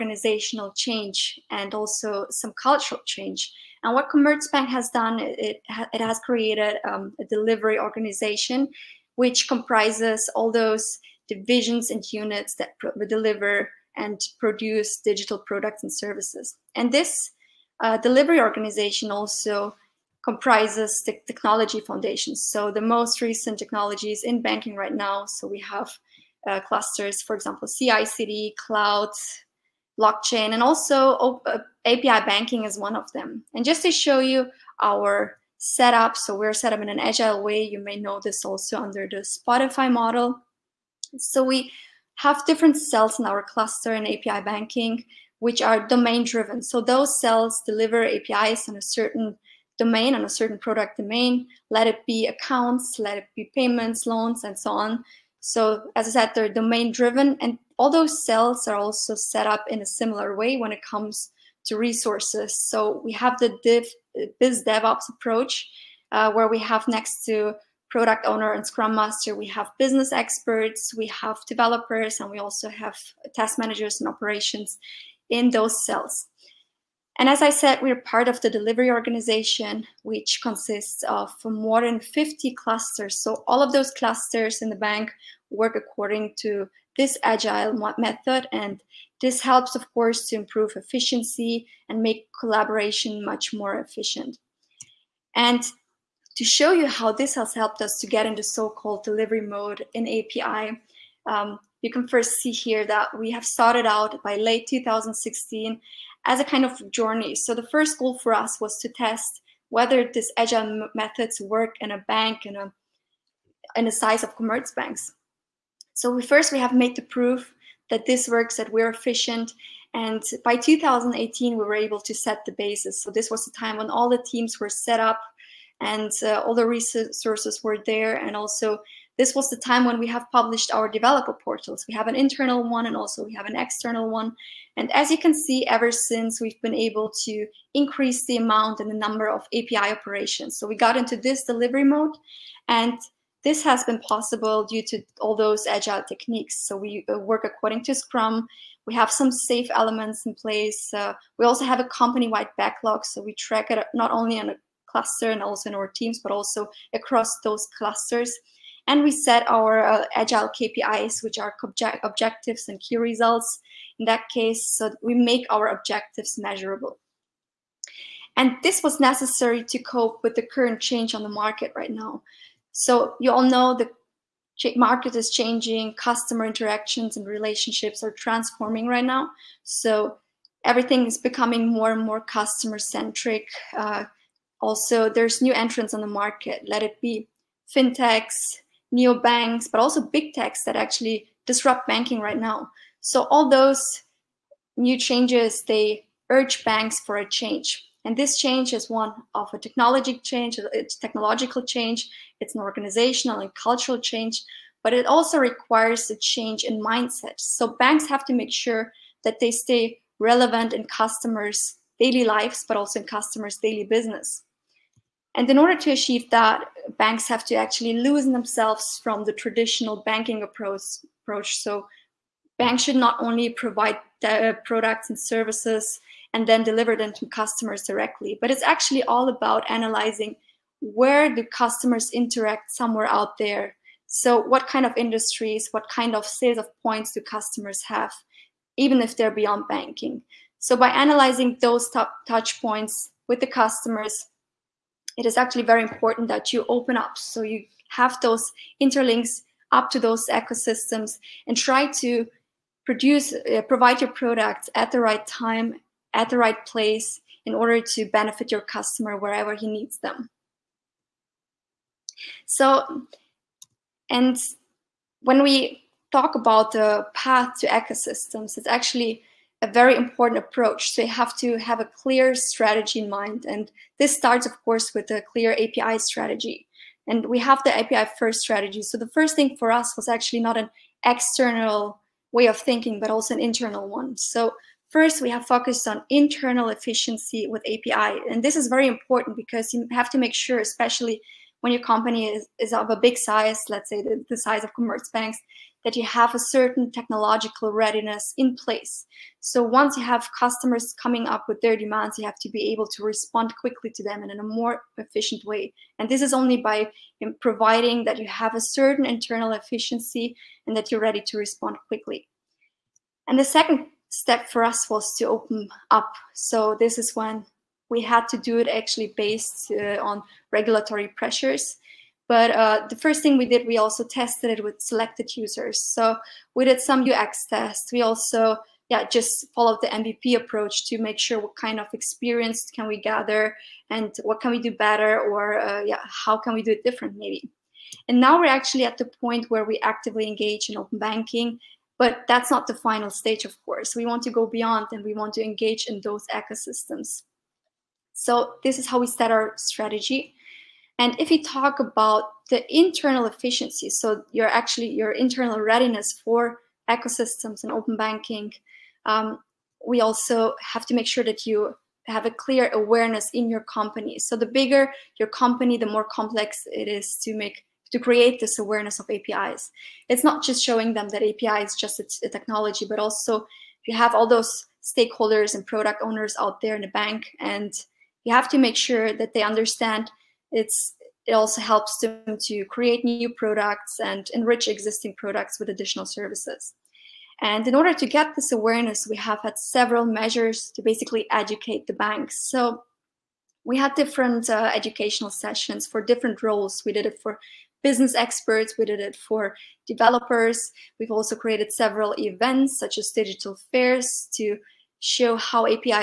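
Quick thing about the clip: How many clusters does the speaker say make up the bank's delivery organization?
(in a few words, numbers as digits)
more than 50.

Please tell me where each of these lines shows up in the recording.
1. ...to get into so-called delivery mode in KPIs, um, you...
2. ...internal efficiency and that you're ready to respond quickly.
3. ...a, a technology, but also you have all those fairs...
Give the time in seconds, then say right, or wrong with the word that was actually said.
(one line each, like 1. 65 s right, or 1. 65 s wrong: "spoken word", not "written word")
1. 97 s wrong: "API", not "KPIs"
2. 309 s right
3. 371 s wrong: "stakeholders", not "fairs".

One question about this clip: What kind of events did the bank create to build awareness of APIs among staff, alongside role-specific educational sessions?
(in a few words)
digital fairs.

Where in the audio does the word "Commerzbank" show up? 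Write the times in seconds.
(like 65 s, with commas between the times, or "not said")
4 s, 114 s.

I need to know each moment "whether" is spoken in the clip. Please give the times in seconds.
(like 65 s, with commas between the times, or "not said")
109 s.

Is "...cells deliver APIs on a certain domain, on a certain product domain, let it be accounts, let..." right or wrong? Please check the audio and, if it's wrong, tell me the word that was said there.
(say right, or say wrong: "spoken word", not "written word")
right.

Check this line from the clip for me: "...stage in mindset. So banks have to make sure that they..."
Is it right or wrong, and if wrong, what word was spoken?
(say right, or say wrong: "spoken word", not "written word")
wrong: "change", not "stage".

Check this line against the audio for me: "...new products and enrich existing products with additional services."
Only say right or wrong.
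right.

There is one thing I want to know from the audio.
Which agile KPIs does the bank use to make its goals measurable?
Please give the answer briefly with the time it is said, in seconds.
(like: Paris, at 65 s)
objectives and key results, at 162 s.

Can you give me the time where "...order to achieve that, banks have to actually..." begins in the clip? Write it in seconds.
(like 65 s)
215 s.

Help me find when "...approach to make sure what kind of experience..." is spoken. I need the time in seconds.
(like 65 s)
330 s.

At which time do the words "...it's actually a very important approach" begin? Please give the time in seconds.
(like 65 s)
268 s.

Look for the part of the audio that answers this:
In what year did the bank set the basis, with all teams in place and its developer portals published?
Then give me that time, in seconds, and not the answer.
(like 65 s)
120 s.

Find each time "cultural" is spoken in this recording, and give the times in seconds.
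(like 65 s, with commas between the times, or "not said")
2 s, 203 s.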